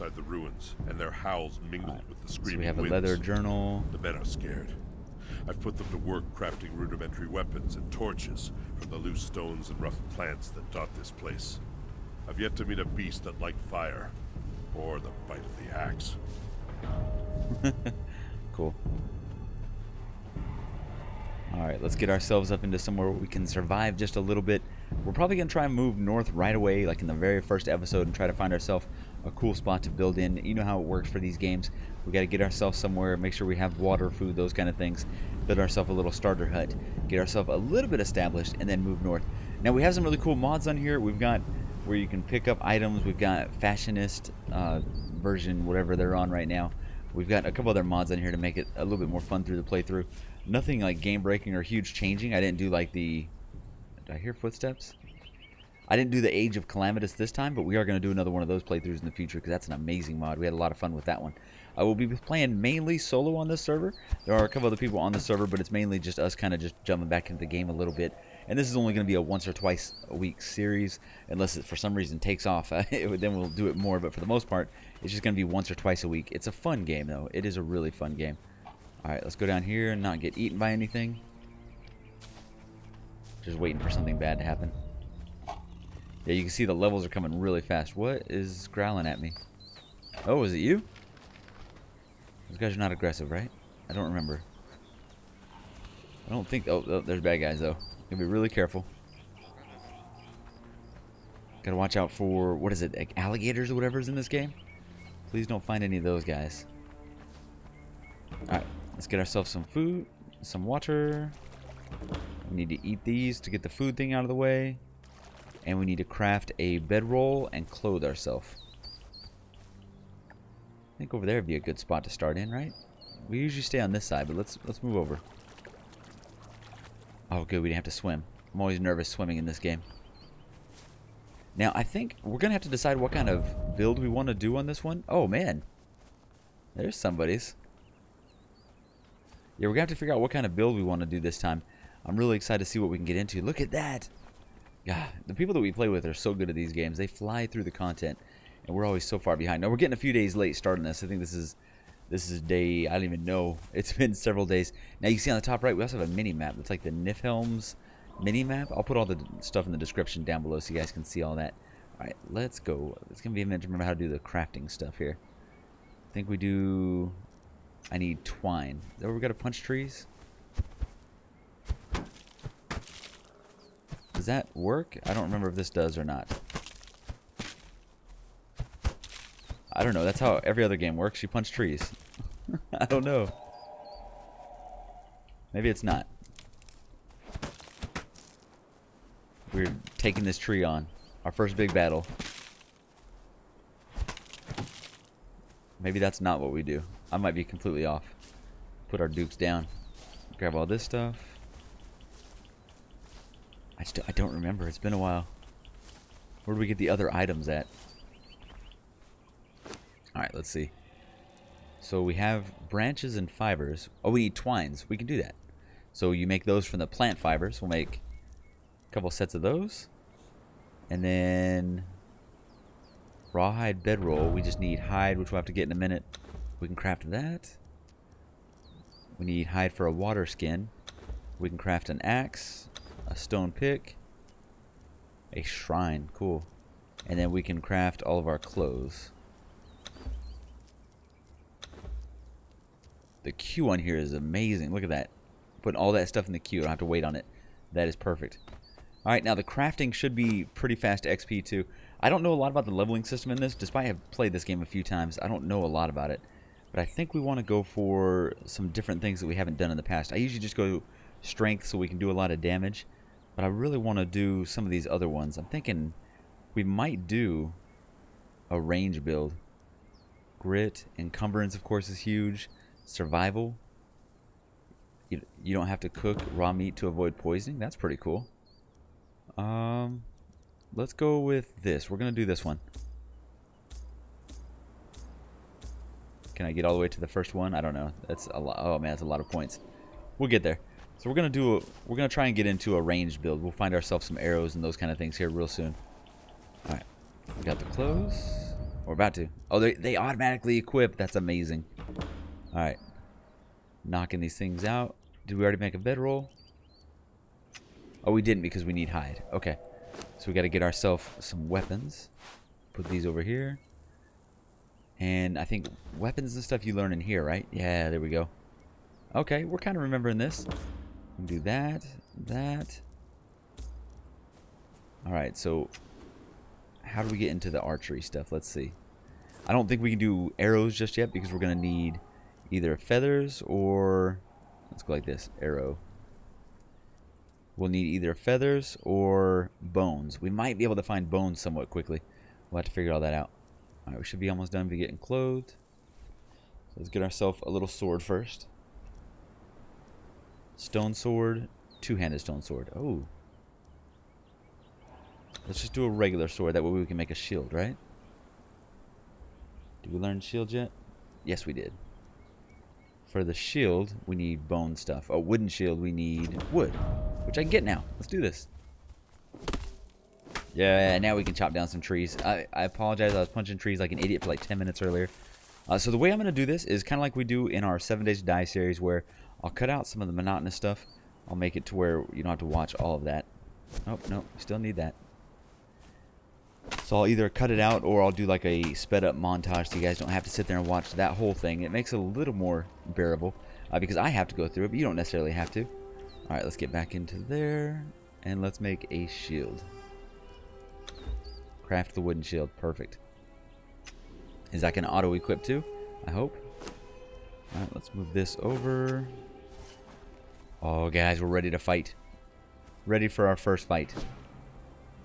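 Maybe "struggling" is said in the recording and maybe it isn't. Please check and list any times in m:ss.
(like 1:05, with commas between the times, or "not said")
not said.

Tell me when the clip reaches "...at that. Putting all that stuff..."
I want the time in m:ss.
4:04.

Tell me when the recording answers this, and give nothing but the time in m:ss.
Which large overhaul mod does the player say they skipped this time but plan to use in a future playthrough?
0:56.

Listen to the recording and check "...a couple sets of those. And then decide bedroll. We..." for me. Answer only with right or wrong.
wrong.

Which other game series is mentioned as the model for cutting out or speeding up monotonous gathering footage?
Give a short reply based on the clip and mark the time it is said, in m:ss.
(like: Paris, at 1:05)
7 Days to Die, at 6:17.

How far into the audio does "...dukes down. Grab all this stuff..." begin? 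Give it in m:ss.
3:19.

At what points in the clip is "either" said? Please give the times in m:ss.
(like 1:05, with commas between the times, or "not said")
5:32, 5:37, 6:27.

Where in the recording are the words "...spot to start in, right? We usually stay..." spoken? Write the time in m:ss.
2:01.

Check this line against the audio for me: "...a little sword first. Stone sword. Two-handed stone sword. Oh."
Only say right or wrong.
right.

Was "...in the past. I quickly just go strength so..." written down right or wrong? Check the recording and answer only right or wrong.
wrong.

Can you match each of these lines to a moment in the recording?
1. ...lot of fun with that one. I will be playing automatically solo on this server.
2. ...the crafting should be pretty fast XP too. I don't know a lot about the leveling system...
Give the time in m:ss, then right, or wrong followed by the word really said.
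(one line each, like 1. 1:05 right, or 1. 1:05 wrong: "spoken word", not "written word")
1. 1:00 wrong: "mainly", not "automatically"
2. 4:09 right.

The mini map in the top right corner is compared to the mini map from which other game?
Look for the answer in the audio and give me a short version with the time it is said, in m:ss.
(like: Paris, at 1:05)
Niflheim, at 2:36.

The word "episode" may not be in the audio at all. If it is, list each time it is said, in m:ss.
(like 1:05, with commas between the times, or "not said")
0:27.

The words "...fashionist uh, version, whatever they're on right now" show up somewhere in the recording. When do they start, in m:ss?
0:43.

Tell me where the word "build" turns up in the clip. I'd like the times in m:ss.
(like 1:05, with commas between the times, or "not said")
0:29, 0:35, 2:13, 2:20, 4:29, 4:53.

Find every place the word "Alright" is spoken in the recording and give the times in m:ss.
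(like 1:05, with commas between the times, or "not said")
0:21, 1:48, 3:30, 5:25, 5:43, 6:36, 6:47.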